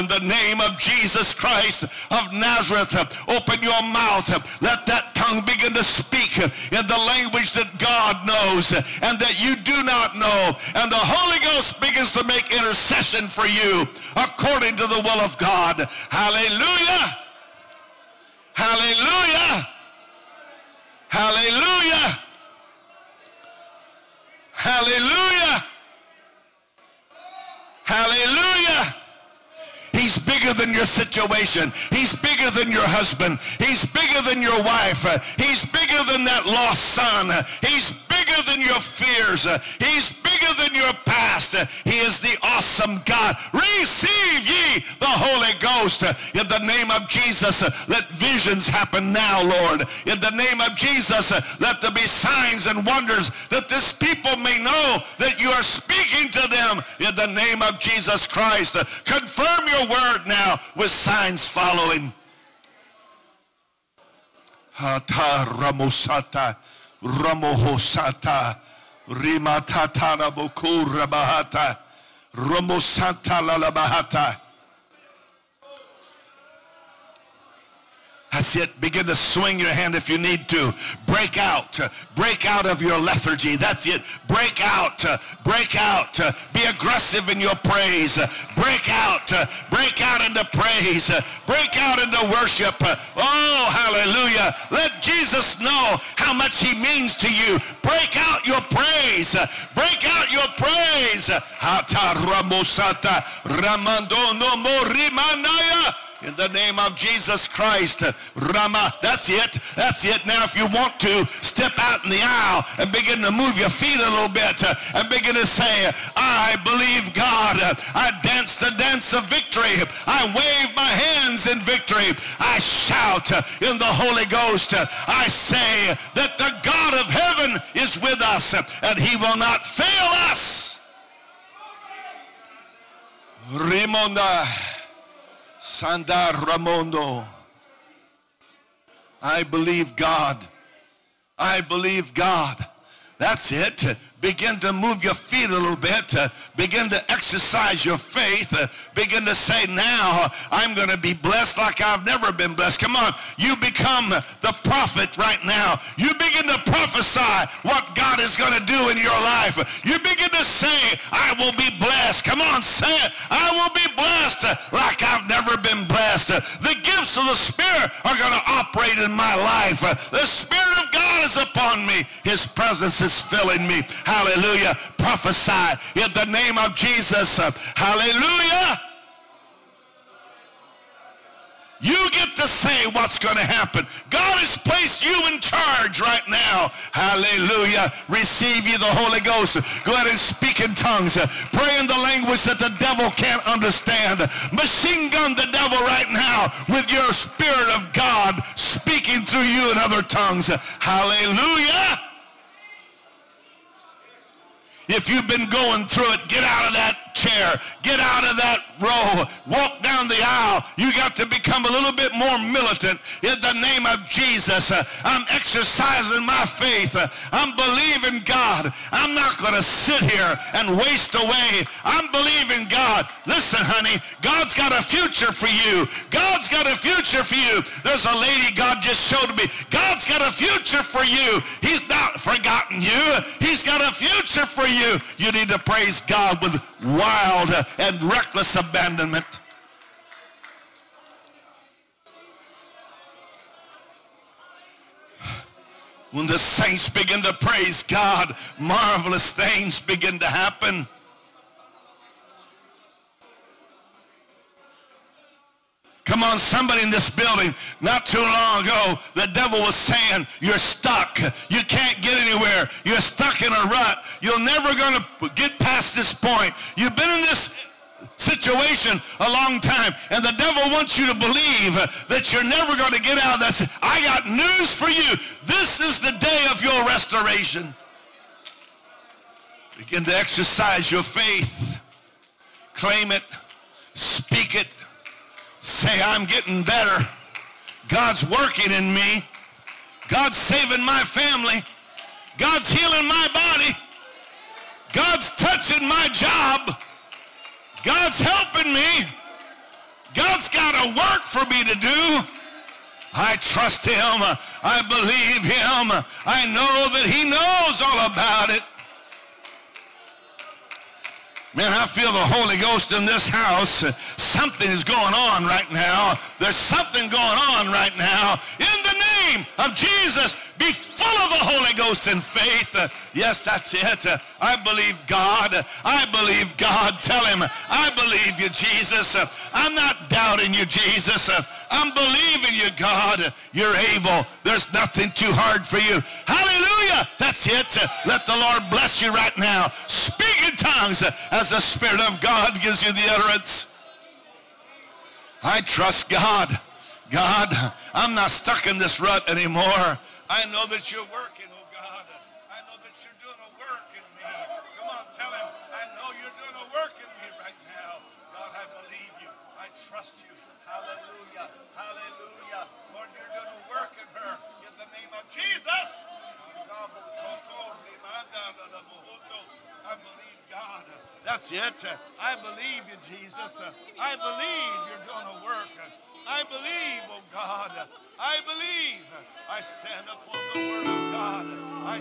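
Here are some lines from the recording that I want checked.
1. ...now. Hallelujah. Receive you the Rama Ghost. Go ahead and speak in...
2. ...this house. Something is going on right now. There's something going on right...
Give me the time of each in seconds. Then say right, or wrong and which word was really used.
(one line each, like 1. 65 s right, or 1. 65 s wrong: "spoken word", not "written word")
1. 186 s wrong: "Holy", not "Rama"
2. 313 s right.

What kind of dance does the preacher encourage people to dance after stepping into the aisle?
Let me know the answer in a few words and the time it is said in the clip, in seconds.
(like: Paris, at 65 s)
the dance of victory, at 118 s.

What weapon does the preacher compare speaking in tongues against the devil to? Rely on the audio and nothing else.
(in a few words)
machine gun.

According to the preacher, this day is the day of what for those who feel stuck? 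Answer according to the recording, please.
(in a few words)
restoration.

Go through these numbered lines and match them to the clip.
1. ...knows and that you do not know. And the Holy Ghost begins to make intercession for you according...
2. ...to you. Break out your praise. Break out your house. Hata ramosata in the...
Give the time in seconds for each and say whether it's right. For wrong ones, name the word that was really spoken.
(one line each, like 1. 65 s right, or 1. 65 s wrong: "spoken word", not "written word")
1. 8 s right
2. 97 s wrong: "praise", not "house".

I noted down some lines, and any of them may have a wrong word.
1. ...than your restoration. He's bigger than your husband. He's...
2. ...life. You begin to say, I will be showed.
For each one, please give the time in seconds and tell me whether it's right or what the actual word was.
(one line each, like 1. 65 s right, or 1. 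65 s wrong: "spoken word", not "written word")
1. 30 s wrong: "situation", not "restoration"
2. 159 s wrong: "blessed", not "showed".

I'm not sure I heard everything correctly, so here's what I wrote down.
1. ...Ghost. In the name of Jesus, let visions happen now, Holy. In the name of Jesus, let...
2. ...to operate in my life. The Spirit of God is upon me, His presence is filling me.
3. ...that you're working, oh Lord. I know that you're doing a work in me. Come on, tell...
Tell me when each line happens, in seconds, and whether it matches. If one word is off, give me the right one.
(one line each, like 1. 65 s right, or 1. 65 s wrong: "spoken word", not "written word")
1. 45 s wrong: "Lord", not "Holy"
2. 168 s right
3. 350 s wrong: "God", not "Lord".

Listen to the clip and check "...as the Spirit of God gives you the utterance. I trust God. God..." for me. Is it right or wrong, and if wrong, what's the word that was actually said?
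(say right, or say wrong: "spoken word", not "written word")
right.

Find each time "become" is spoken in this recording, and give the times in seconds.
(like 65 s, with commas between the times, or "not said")
153 s, 211 s.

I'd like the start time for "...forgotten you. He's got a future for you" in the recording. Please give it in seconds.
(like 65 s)
232 s.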